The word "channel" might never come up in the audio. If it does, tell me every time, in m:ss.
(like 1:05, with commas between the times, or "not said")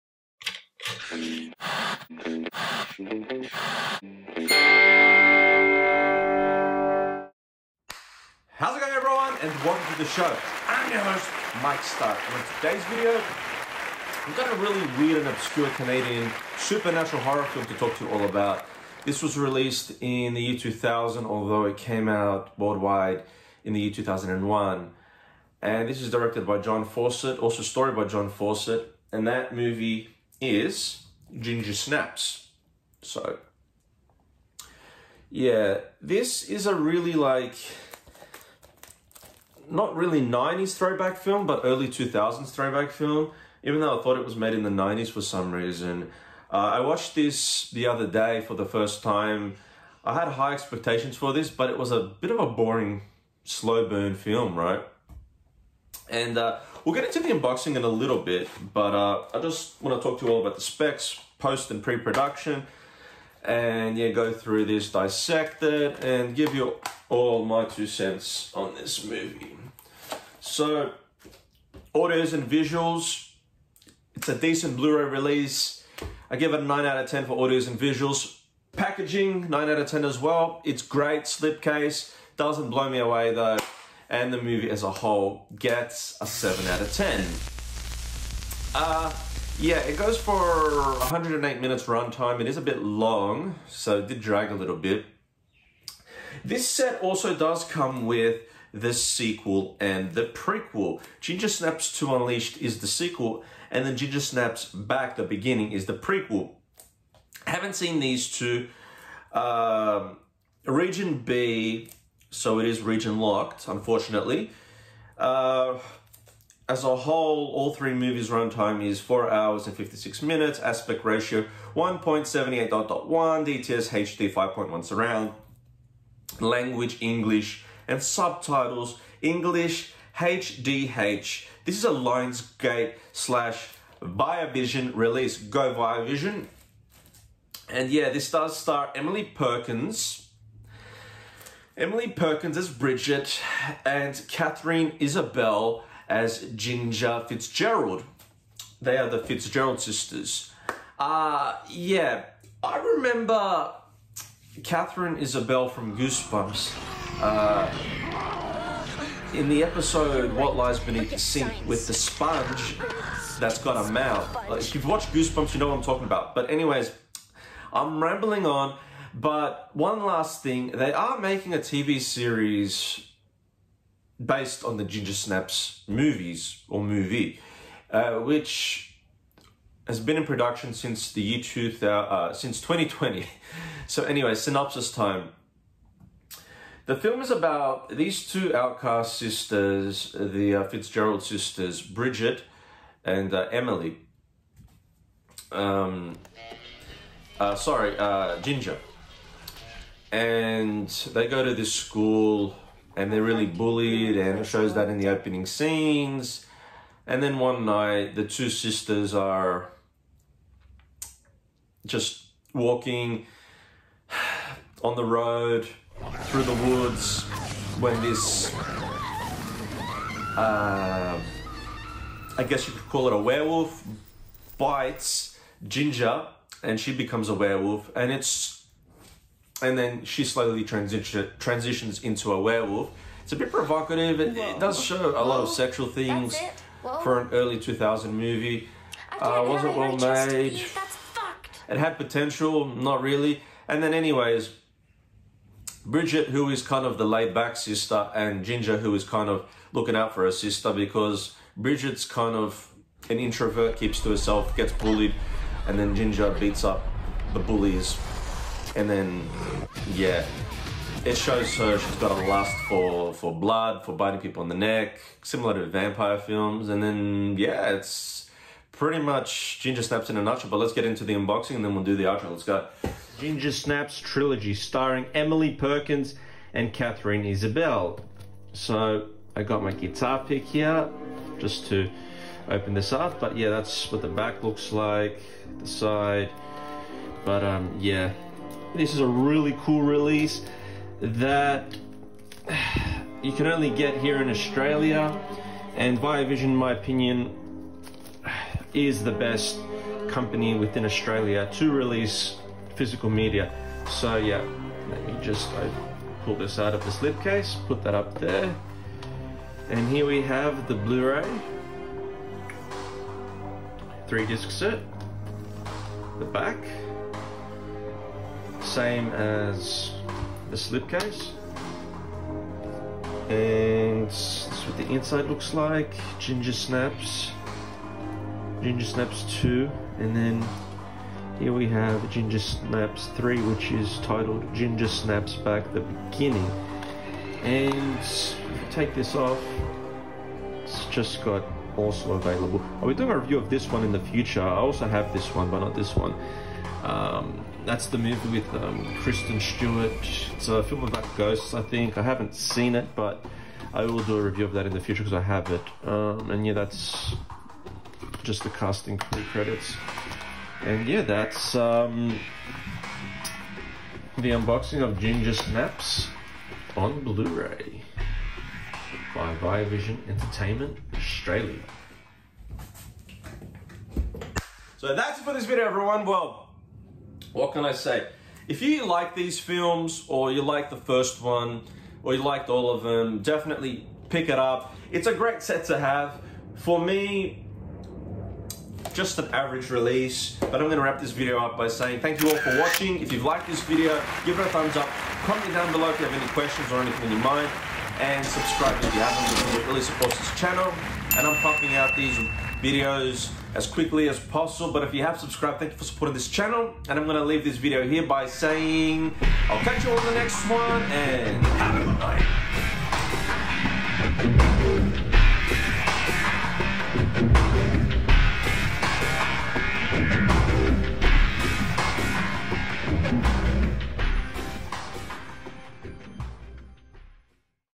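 6:40, 6:46.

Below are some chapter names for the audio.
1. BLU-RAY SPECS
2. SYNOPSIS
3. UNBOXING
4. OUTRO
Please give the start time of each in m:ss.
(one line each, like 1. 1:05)
1. 1:16
2. 3:03
3. 4:45
4. 6:27.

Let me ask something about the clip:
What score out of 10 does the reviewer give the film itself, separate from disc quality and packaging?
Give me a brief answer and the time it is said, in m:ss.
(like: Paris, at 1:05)
7, at 1:26.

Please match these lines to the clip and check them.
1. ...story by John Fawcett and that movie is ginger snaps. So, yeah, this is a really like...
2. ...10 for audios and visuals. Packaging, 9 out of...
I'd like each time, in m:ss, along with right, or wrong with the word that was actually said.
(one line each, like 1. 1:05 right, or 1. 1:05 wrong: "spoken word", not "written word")
1. 0:27 right
2. 1:17 right.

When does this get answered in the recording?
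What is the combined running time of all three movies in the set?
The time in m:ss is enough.
1:59.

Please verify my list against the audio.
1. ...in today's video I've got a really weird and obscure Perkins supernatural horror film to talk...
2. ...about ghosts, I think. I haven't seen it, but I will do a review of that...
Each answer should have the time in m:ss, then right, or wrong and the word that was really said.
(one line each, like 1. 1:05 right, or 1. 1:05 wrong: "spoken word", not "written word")
1. 0:12 wrong: "Canadian", not "Perkins"
2. 5:50 right.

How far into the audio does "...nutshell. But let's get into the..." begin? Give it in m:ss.
4:30.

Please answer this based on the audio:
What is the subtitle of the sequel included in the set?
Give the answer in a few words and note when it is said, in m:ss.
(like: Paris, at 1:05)
Unleashed, at 1:42.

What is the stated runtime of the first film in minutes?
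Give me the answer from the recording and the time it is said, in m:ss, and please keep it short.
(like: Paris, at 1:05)
108, at 1:30.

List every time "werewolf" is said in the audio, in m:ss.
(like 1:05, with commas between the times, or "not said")
3:43, 3:47, 3:52.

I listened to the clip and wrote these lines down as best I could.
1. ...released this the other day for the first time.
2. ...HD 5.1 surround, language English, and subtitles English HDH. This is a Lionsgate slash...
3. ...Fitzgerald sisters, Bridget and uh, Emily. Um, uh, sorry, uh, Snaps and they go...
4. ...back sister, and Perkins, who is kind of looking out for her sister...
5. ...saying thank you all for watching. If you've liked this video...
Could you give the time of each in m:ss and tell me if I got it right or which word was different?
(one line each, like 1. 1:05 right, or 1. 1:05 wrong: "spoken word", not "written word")
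1. 0:46 wrong: "watched", not "released"
2. 2:03 right
3. 3:10 wrong: "Ginger", not "Snaps"
4. 4:07 wrong: "Ginger", not "Perkins"
5. 6:31 right.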